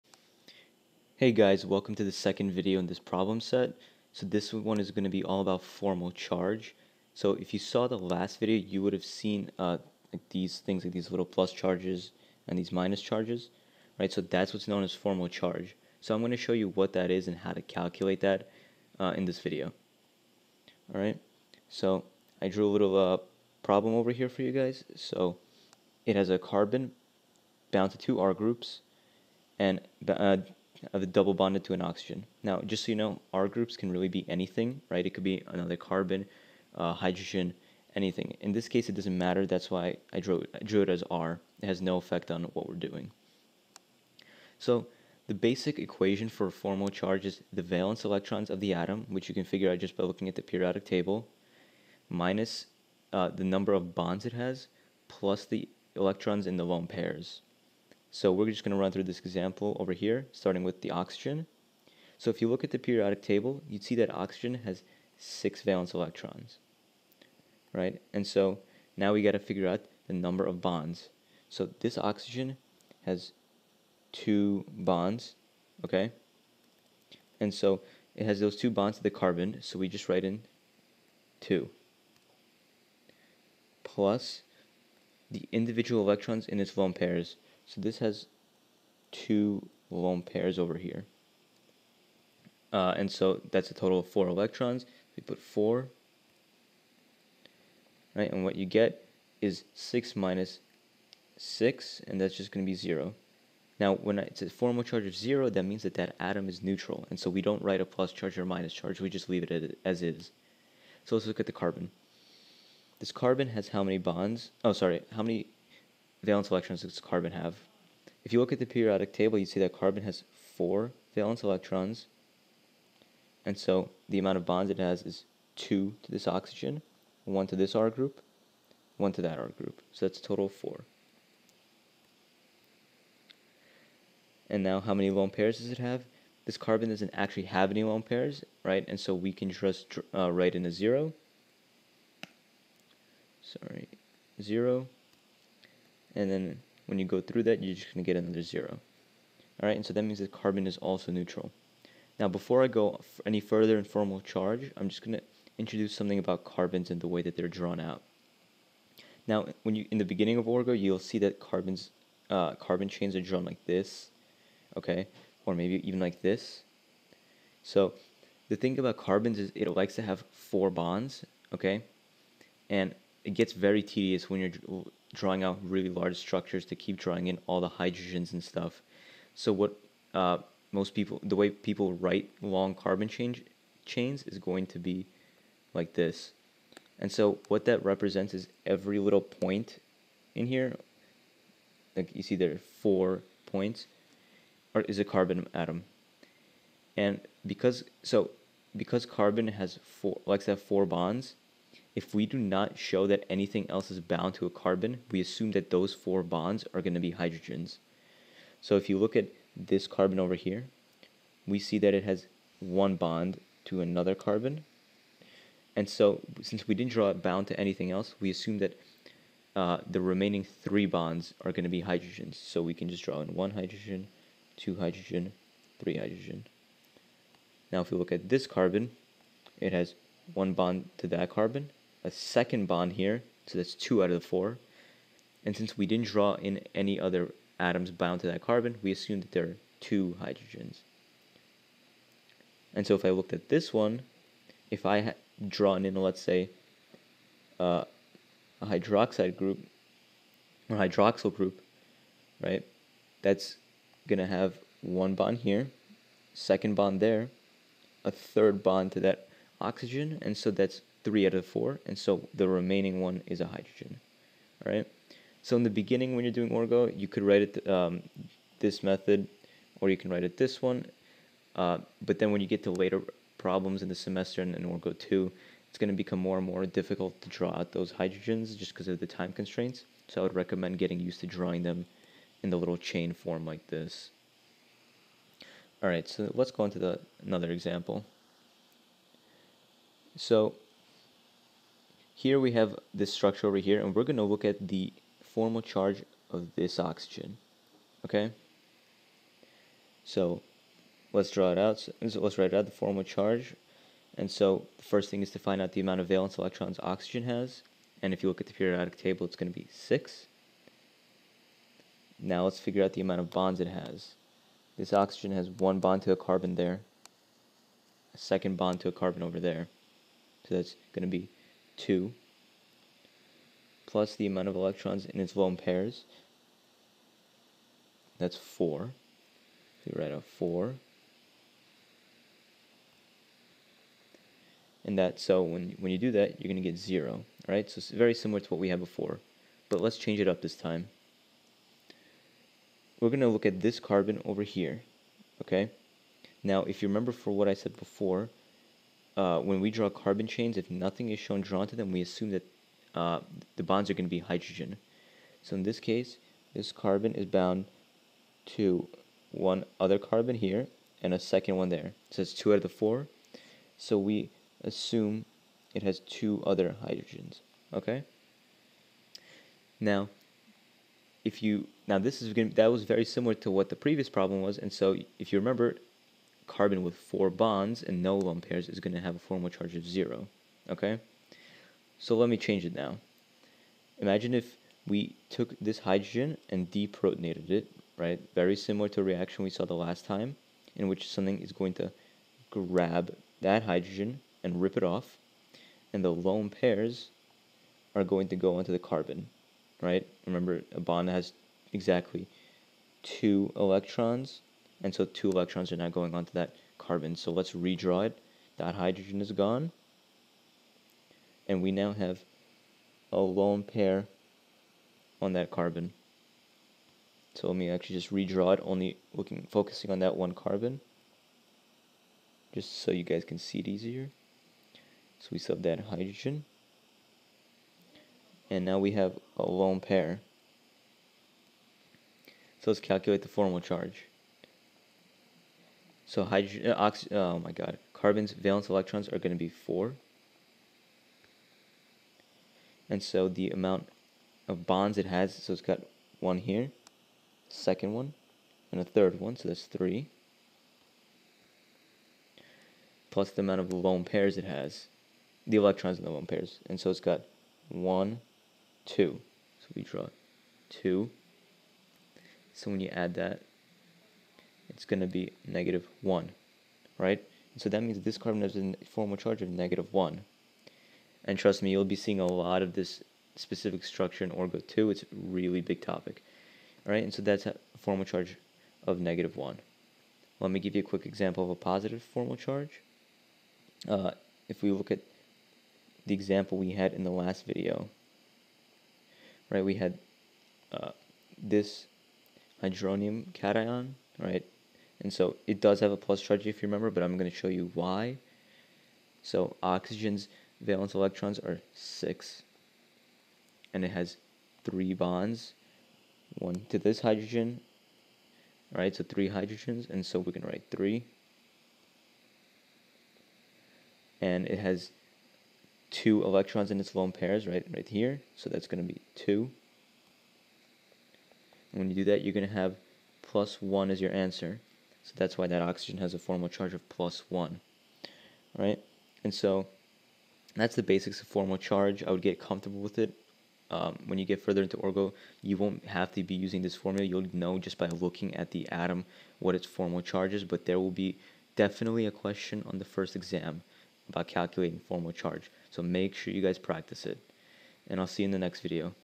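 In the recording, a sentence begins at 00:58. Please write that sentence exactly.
So we're just going to run through this example over here, starting with the oxygen.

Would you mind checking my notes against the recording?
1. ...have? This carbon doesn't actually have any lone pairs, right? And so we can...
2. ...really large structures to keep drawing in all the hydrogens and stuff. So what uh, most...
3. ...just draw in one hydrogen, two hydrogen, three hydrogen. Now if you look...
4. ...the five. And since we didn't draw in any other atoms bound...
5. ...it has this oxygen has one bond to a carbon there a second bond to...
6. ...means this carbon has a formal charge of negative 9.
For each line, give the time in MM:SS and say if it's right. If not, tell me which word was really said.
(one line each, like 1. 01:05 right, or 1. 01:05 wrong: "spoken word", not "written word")
1. 02:15 right
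2. 02:55 right
3. 03:42 right
4. 03:54 wrong: "four", not "five"
5. 05:13 right
6. 07:47 wrong: "1", not "9".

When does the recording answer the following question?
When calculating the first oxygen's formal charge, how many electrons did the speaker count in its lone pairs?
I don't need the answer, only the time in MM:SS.
01:33.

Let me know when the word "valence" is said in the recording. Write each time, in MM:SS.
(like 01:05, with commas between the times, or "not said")
00:47, 01:05, 01:56, 02:01, 05:06, 07:18, 08:20.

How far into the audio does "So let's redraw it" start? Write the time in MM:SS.
06:47.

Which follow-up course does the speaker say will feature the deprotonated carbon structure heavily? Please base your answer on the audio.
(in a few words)
Orgo 2.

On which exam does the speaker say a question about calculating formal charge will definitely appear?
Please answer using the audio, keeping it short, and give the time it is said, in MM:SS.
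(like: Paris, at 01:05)
The first exam, at 09:02.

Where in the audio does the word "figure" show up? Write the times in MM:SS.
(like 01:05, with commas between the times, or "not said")
00:49, 01:09, 05:12.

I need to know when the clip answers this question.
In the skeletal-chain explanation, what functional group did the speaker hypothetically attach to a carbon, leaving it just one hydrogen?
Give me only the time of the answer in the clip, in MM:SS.
04:10.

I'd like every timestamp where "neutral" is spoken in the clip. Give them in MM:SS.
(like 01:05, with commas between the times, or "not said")
01:46, 02:31.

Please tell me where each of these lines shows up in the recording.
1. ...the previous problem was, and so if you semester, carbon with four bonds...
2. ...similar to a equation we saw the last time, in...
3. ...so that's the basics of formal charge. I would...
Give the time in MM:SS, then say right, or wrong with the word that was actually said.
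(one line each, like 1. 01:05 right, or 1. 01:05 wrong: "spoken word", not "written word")
1. 06:13 wrong: "remember", not "semester"
2. 06:28 wrong: "reaction", not "equation"
3. 08:49 right.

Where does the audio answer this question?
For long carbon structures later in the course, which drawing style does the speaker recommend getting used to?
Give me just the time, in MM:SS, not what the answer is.
04:42.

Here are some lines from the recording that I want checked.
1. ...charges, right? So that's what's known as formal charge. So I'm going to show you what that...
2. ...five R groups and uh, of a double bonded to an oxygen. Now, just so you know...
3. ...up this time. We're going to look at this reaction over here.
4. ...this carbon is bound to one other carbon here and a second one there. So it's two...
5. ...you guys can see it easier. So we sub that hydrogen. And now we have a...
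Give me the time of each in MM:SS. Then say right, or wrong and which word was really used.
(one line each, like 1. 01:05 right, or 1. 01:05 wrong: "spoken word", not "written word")
1. 00:13 right
2. 00:27 wrong: "two", not "five"
3. 05:40 wrong: "carbon", not "reaction"
4. 05:56 right
5. 07:02 right.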